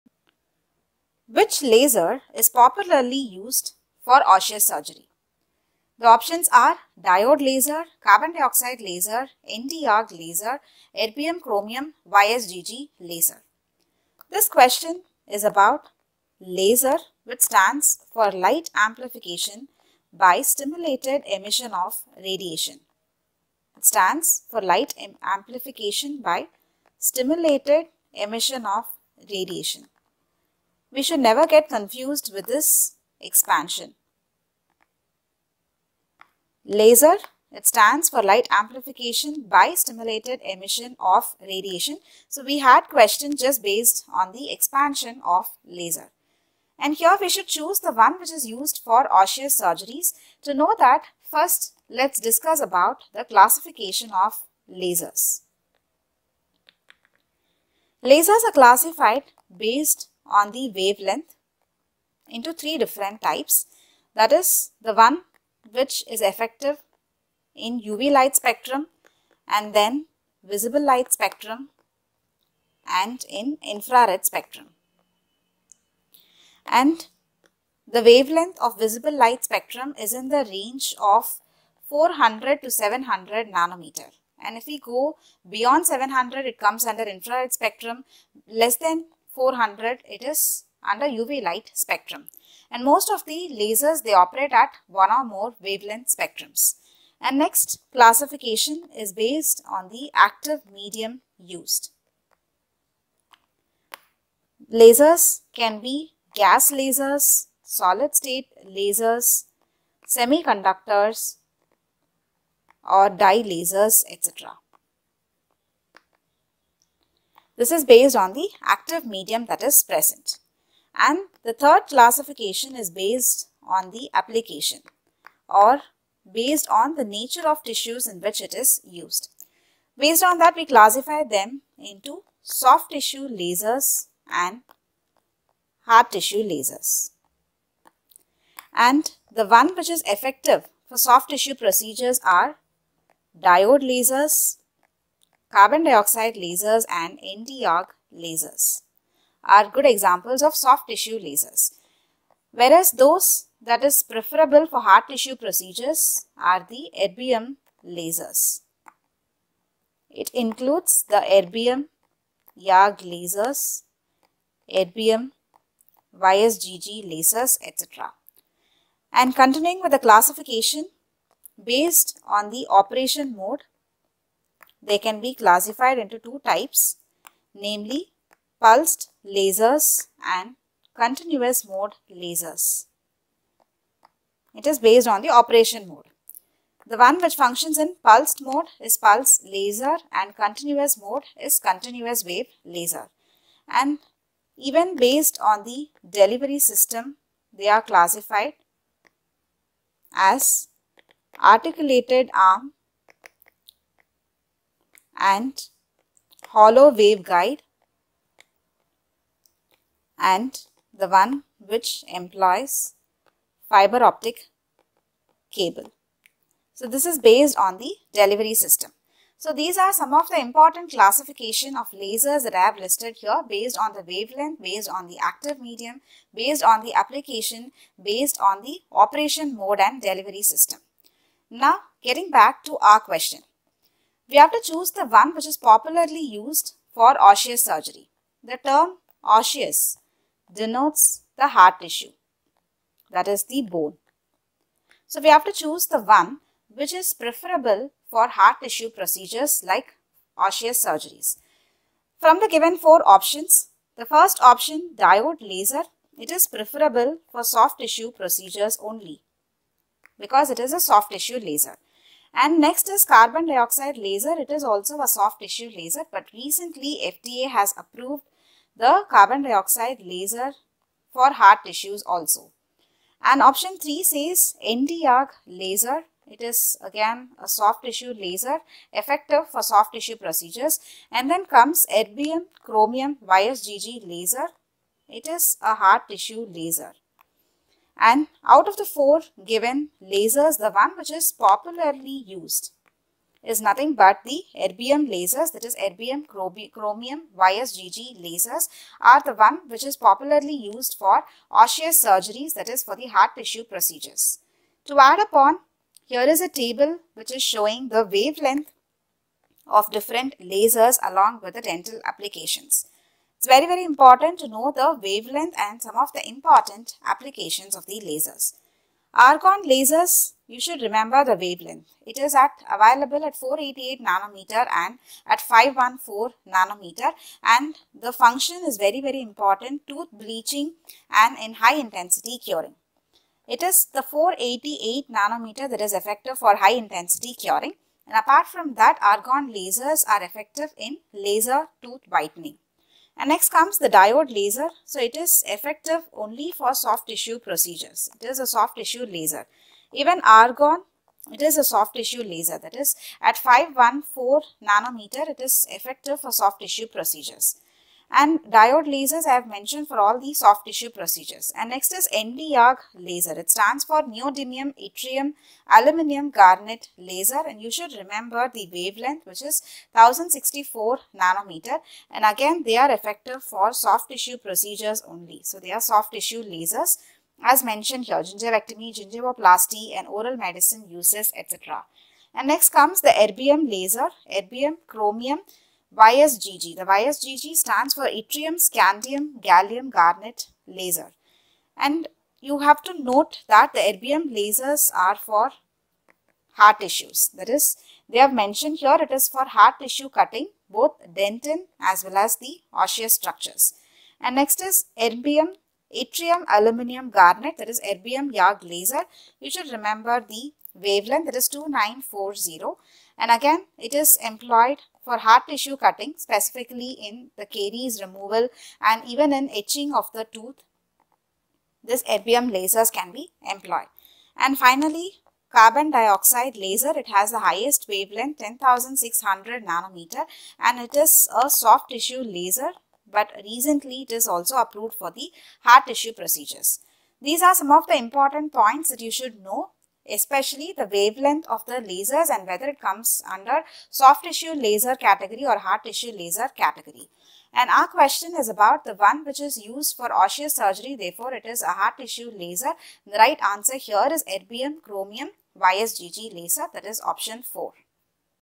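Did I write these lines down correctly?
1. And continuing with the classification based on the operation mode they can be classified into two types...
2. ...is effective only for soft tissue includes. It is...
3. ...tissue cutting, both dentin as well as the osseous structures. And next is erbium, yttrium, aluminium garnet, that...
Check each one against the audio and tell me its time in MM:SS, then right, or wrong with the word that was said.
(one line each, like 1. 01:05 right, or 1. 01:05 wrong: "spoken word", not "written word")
1. 02:49 right
2. 05:45 wrong: "procedures", not "includes"
3. 06:39 right.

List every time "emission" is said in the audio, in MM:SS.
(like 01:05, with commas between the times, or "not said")
00:21, 00:28, 00:40.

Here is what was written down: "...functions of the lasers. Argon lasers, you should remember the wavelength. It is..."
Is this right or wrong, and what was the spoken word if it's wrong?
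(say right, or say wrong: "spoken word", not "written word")
wrong: "applications", not "functions".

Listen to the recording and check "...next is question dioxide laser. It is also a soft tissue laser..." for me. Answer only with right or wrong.
wrong.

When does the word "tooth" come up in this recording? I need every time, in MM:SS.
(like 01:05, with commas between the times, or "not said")
05:29, 05:41, 07:00.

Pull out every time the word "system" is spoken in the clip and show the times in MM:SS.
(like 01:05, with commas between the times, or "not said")
03:16, 03:38, 03:50.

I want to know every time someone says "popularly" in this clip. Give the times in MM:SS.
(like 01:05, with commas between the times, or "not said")
00:02, 03:55, 04:51, 04:59.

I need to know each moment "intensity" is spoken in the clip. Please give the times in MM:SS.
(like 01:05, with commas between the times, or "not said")
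05:31, 05:36.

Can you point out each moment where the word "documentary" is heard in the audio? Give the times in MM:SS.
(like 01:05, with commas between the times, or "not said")
not said.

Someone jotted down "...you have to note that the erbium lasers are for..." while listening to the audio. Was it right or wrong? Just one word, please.
right.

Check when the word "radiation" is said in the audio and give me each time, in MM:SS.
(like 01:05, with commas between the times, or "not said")
00:22, 00:29, 00:41.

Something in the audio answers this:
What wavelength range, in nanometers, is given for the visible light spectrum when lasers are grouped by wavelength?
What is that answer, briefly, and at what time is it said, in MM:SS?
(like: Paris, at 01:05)
400 to 700, at 01:21.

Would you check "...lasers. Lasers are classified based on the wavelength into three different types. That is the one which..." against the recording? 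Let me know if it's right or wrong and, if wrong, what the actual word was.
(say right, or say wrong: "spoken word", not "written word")
right.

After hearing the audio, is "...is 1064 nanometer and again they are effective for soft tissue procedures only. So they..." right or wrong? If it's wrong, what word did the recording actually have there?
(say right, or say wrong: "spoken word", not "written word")
right.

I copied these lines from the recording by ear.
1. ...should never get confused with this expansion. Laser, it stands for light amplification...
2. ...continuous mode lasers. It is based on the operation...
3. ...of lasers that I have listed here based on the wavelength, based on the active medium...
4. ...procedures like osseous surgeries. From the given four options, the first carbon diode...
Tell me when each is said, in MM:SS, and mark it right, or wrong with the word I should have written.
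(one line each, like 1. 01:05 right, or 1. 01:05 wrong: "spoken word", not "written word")
1. 00:31 right
2. 03:00 right
3. 03:41 right
4. 04:08 wrong: "option", not "carbon".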